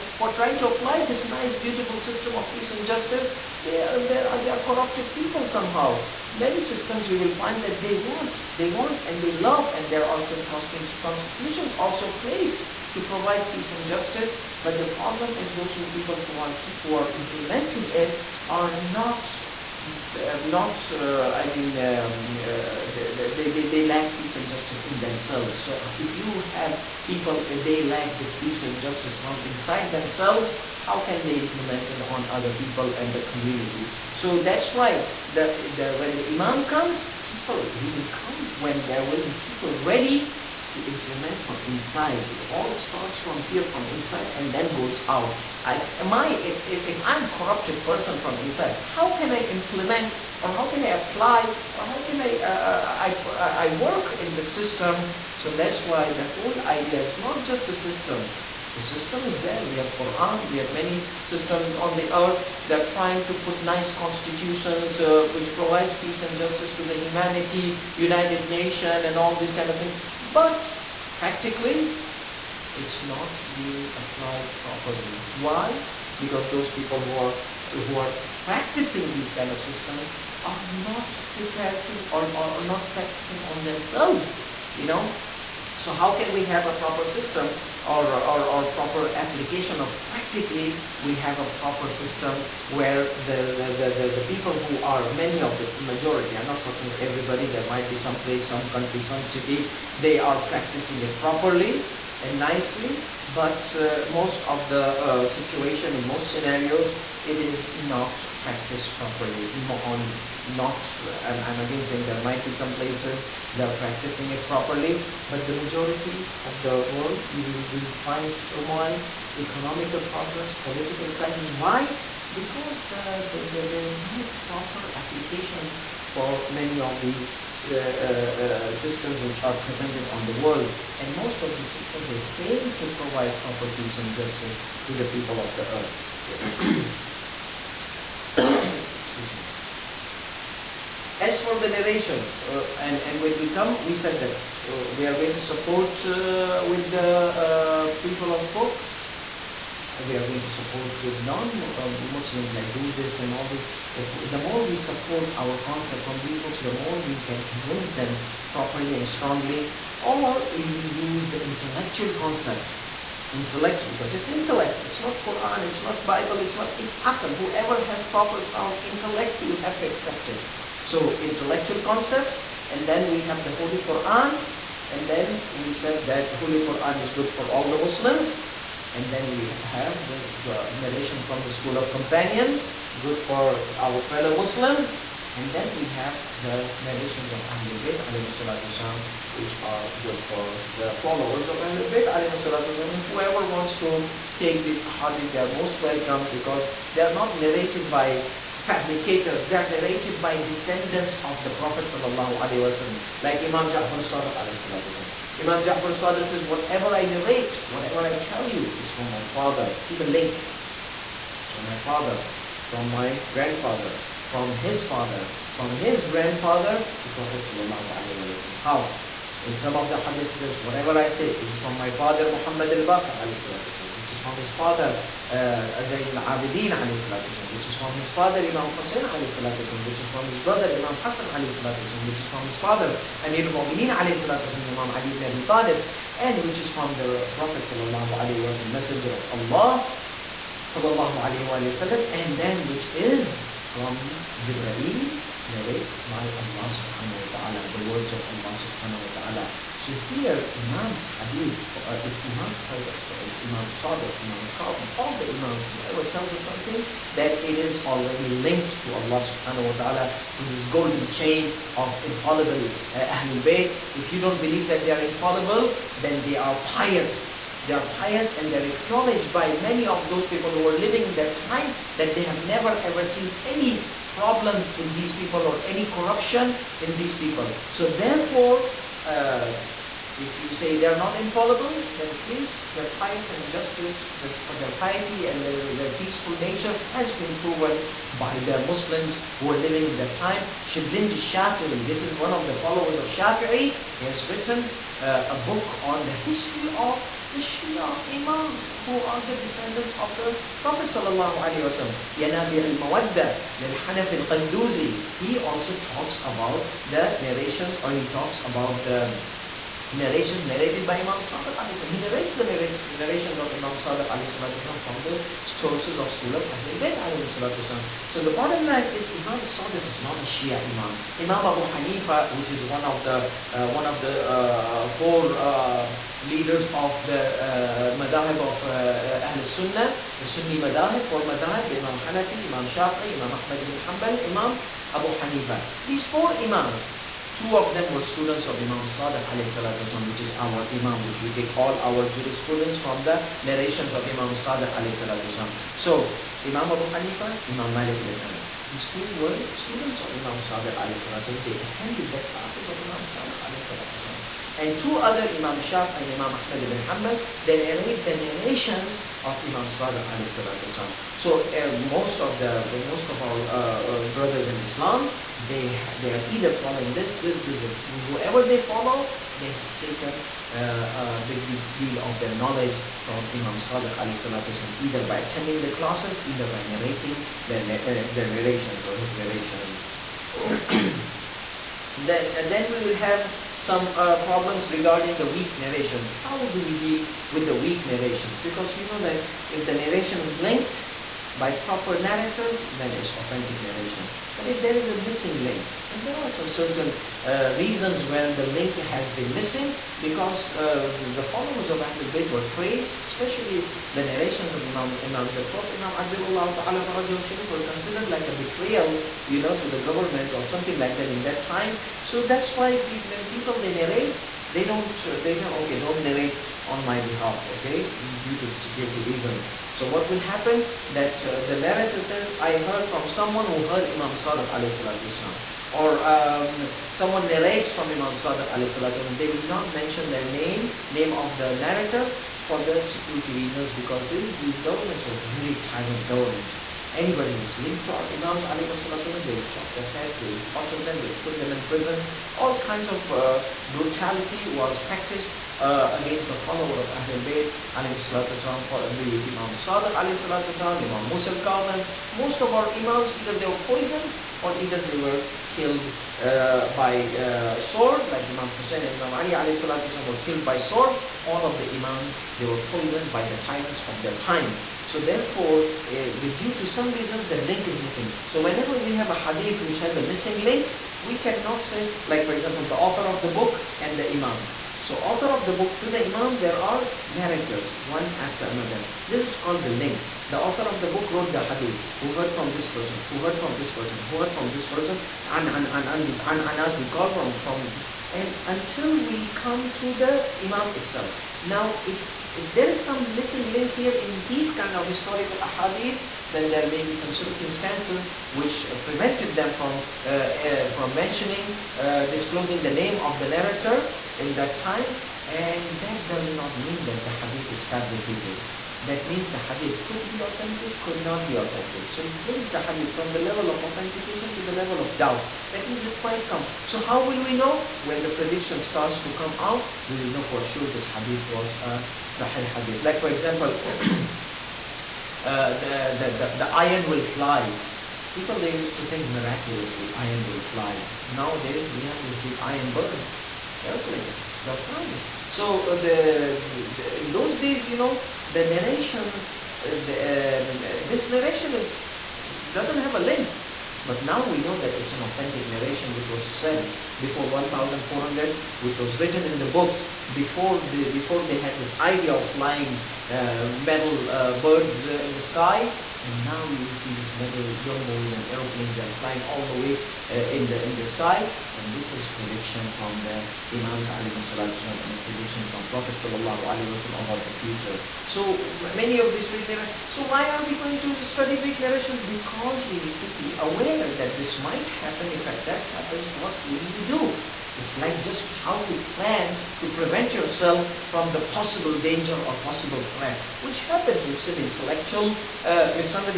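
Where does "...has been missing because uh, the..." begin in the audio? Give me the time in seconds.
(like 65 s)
398 s.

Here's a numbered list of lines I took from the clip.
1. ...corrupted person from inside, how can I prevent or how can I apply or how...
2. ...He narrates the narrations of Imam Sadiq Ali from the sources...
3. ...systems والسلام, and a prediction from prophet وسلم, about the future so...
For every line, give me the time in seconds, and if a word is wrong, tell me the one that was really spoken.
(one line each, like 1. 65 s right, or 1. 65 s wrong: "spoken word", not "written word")
1. 47 s wrong: "implement", not "prevent"
2. 311 s right
3. 563 s wrong: "imams", not "systems".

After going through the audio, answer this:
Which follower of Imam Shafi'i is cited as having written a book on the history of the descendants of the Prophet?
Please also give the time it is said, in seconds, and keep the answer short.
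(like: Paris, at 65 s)
Shablanji Shafi'i, at 290 s.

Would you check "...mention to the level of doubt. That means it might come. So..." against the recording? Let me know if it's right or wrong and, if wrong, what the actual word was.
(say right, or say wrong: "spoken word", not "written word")
wrong: "authentication", not "mention".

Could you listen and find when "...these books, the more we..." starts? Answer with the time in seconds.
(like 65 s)
156 s.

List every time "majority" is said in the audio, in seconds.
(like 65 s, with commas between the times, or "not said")
95 s, 115 s.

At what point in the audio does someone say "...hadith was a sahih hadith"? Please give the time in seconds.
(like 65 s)
520 s.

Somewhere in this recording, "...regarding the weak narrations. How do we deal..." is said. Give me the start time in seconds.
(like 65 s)
384 s.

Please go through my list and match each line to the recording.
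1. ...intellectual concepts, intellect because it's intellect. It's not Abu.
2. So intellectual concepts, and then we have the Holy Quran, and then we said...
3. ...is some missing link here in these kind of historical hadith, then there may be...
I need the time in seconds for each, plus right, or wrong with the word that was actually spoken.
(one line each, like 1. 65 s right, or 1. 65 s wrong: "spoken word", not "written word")
1. 161 s wrong: "Quran", not "Abu"
2. 170 s right
3. 492 s right.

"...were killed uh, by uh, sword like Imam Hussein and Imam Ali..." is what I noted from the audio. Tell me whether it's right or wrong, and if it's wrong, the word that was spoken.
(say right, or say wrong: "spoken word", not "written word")
right.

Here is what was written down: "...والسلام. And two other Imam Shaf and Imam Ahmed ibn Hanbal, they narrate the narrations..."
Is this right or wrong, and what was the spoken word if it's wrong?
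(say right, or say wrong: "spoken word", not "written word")
right.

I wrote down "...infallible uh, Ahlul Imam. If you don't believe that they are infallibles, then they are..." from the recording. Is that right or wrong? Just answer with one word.
wrong.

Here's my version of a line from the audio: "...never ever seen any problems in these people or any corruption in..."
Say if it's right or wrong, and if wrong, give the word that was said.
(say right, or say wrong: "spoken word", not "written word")
right.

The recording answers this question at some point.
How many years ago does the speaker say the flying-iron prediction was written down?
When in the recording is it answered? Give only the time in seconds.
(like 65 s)
547 s.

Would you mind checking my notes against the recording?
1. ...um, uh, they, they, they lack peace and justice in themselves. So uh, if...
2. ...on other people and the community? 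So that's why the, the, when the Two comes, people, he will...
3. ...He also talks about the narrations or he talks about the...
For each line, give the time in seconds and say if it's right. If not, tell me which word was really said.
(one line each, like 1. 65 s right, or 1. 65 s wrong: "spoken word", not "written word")
1. 21 s right
2. 32 s wrong: "Imam", not "Two"
3. 305 s right.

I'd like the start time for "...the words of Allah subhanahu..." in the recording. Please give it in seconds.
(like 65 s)
247 s.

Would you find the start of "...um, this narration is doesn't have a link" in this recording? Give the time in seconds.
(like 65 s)
540 s.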